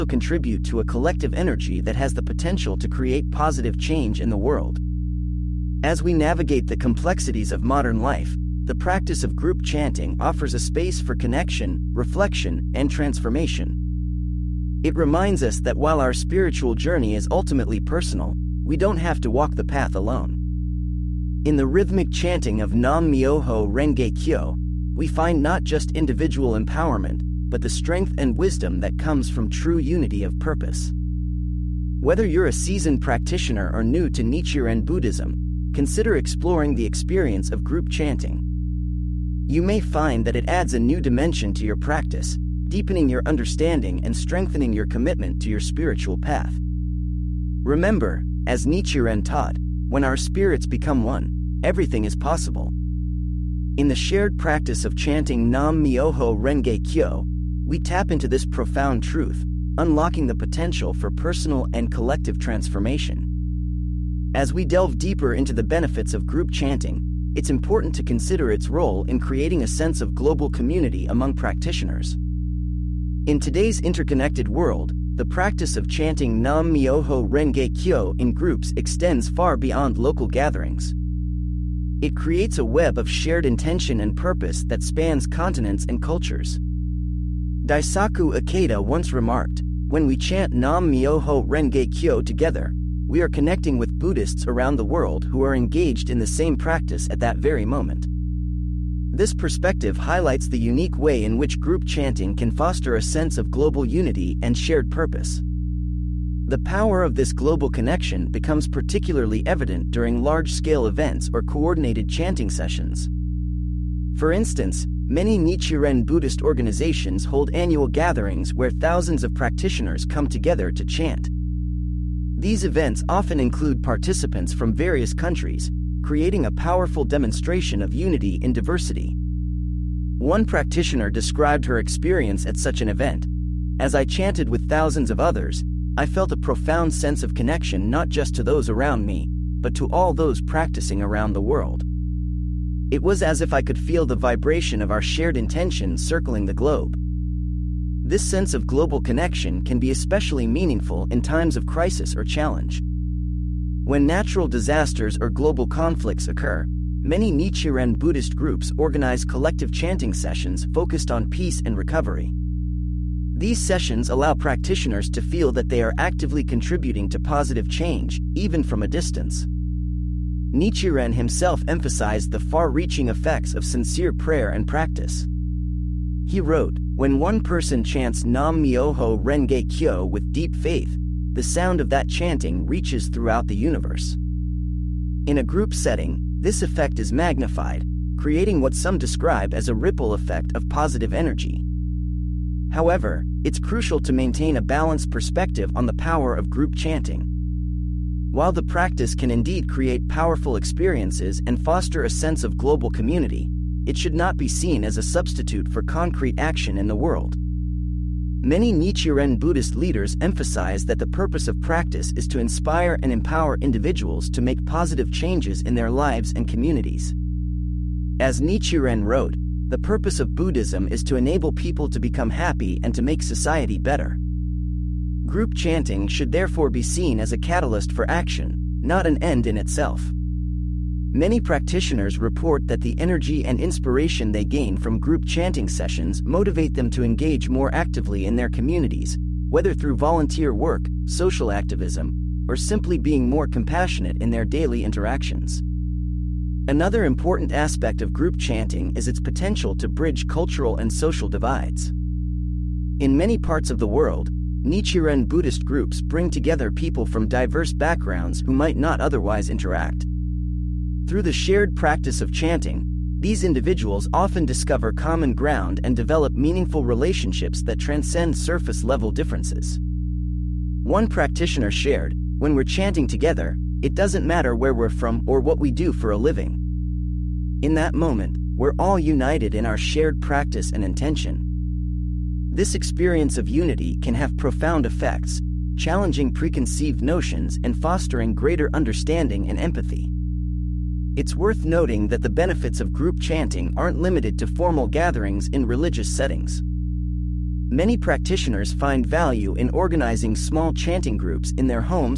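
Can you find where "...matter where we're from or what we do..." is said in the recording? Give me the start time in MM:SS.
04:34.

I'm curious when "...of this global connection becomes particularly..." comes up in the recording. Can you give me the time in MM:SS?
01:47.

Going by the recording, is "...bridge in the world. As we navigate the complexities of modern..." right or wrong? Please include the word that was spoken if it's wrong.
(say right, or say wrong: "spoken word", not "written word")
wrong: "change", not "bridge".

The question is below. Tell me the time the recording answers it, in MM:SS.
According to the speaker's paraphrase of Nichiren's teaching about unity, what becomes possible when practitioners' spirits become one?
00:51.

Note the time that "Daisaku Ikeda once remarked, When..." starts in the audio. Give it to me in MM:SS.
01:27.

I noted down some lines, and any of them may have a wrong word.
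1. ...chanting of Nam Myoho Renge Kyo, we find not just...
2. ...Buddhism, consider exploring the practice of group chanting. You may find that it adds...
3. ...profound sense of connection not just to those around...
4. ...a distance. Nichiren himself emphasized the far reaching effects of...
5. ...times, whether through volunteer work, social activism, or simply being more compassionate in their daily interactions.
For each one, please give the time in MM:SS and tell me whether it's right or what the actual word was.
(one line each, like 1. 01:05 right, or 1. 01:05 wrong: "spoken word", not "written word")
1. 00:22 right
2. 00:34 wrong: "experience", not "practice"
3. 02:16 right
4. 02:48 right
5. 03:58 wrong: "communities", not "times".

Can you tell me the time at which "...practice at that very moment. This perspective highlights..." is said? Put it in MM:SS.
01:36.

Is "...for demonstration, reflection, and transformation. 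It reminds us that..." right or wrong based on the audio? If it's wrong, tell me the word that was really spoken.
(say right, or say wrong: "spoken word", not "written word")
wrong: "connection", not "demonstration".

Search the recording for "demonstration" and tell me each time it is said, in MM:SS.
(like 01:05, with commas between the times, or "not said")
02:07.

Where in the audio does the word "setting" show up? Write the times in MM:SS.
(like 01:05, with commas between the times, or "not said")
03:05, 04:56.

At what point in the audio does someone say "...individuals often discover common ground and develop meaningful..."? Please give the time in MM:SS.
04:23.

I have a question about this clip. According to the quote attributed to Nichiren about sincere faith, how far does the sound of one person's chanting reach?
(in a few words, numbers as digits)
throughout the universe.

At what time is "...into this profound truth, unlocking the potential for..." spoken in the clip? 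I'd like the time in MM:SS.
00:58.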